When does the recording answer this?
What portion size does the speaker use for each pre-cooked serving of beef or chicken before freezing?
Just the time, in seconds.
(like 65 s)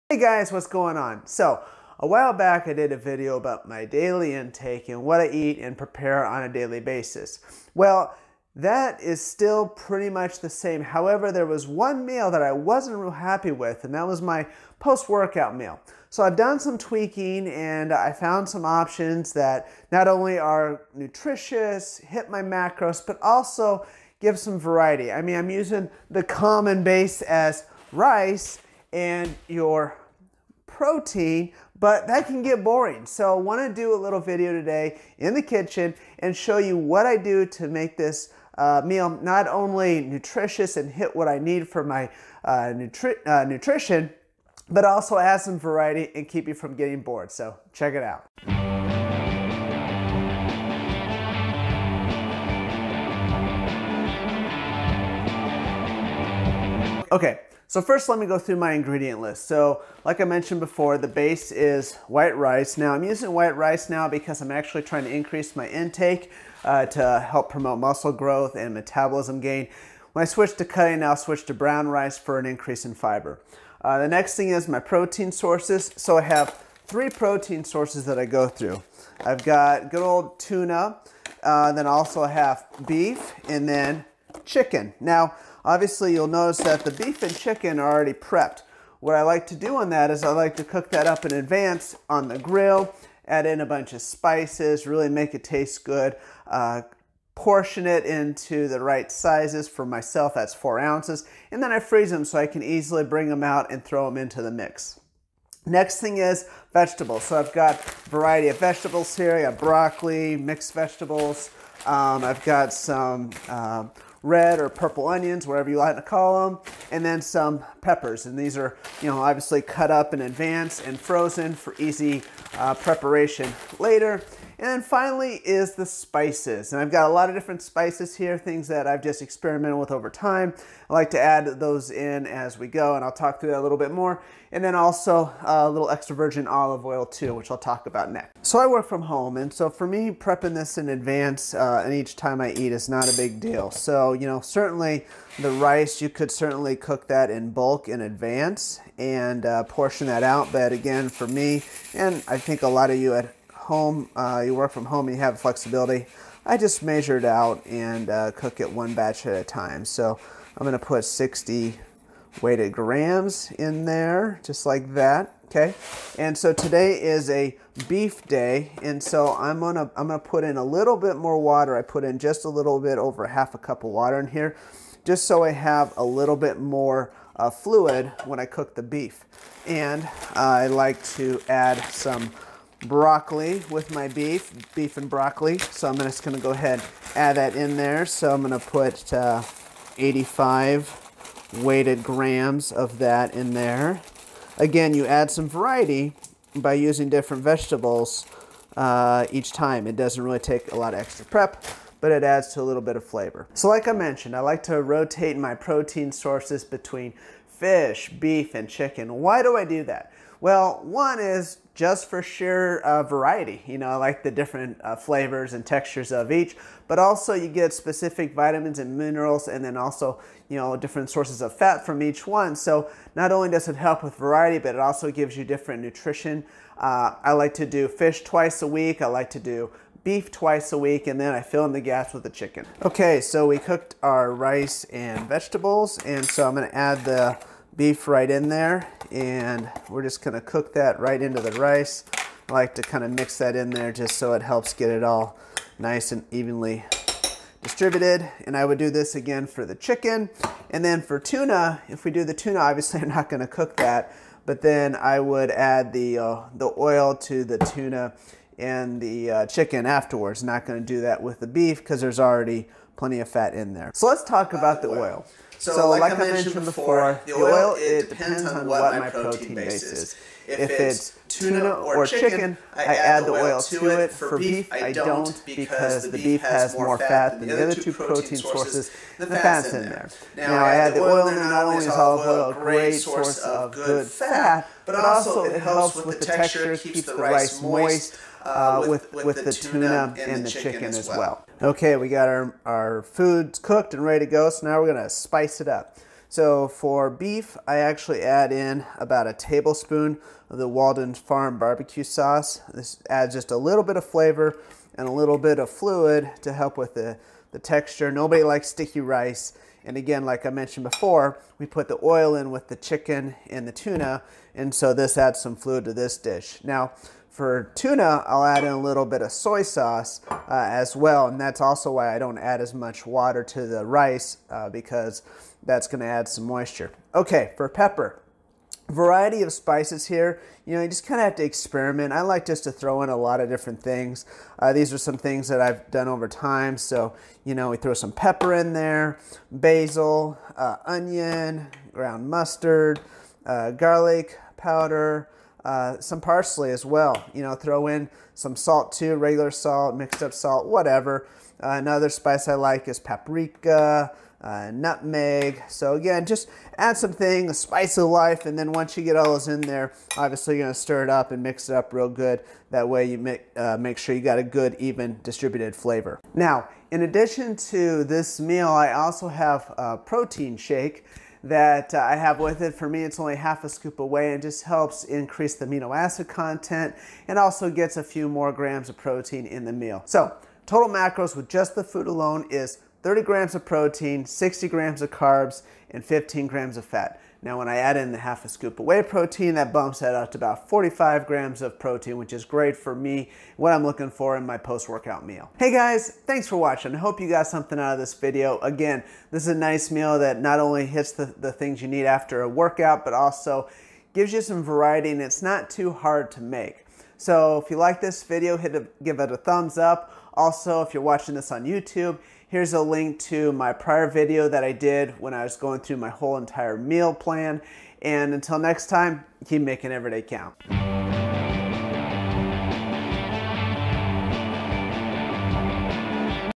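100 s.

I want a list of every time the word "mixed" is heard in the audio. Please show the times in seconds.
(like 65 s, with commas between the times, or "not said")
110 s, 349 s.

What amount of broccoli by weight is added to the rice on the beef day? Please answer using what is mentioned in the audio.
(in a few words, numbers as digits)
85 grams.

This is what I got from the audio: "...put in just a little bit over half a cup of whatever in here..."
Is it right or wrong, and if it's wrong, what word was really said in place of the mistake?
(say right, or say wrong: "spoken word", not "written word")
wrong: "water", not "whatever".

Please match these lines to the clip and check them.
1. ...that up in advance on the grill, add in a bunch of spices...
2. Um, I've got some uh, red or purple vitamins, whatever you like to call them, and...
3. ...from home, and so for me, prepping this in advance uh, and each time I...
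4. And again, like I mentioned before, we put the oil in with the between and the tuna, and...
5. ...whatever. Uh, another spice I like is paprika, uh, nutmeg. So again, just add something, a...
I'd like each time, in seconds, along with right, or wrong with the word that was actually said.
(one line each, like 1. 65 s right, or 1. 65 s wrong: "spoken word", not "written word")
1. 90 s right
2. 111 s wrong: "onions", not "vitamins"
3. 138 s right
4. 309 s wrong: "chicken", not "between"
5. 350 s right.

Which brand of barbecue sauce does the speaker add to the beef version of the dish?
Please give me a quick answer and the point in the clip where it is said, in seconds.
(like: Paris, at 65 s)
Walden Farm, at 300 s.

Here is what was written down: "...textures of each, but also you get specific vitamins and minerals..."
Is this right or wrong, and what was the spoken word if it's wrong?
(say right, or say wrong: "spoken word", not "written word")
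right.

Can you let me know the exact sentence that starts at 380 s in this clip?
So total macros with just the food alone is 30 grams of protein, 60 grams of carbs, and 15 grams of fat.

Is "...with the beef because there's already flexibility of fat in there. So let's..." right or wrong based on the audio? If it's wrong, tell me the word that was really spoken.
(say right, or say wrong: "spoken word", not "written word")
wrong: "plenty", not "flexibility".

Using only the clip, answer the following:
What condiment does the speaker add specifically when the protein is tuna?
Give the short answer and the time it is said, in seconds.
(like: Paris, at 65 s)
soy sauce, at 319 s.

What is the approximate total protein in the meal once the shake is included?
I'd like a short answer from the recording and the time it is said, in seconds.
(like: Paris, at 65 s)
45 grams, at 390 s.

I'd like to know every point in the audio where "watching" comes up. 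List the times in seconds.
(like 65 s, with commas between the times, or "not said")
396 s, 411 s.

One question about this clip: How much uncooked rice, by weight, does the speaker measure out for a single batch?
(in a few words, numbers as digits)
60 grams.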